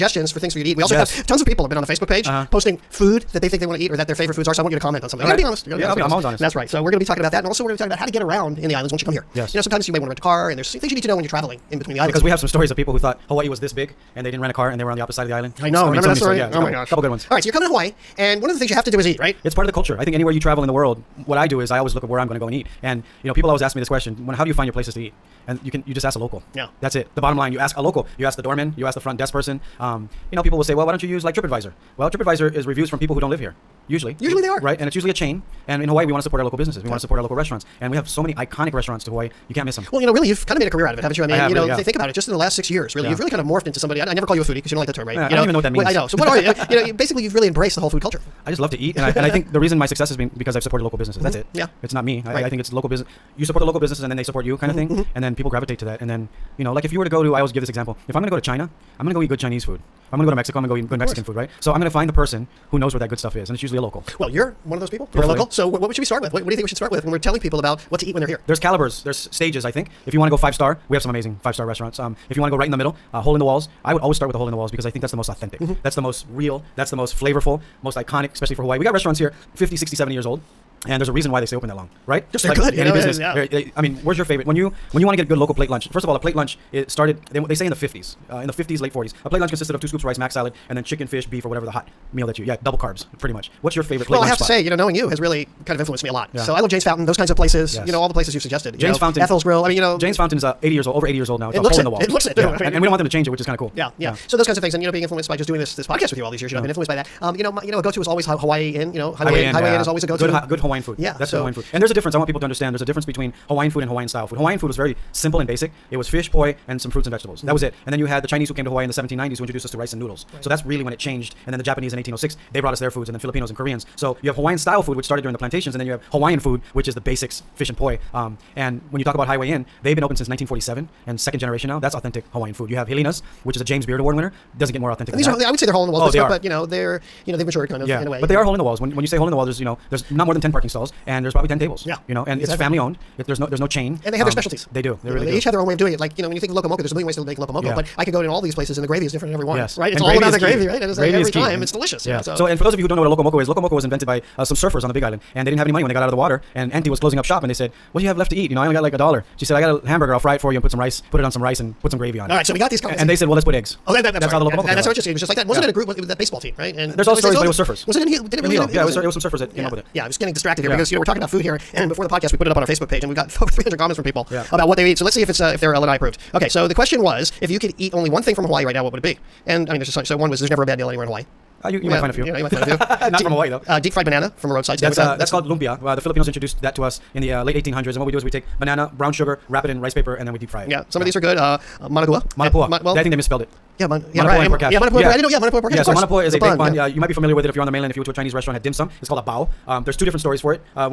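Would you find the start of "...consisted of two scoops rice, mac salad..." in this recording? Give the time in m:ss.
1:29.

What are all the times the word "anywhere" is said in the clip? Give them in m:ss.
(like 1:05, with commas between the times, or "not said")
0:20, 3:00.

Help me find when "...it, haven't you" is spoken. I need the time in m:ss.
0:40.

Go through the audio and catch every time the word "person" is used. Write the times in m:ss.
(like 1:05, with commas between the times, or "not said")
0:29, 1:02.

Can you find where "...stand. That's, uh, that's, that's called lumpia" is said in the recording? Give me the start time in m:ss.
3:04.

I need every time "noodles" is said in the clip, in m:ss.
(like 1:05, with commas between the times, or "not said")
1:59.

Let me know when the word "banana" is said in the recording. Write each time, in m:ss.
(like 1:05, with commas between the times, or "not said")
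3:04, 3:08.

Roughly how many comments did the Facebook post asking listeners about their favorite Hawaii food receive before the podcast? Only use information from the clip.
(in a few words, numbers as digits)
Over 300.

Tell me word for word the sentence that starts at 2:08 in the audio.
Um, and when you talk about Highway Inn, they've been open since 1947 and second generation now.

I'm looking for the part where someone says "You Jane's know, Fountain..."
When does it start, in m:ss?
1:38.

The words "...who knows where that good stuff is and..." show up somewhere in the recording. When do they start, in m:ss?
1:02.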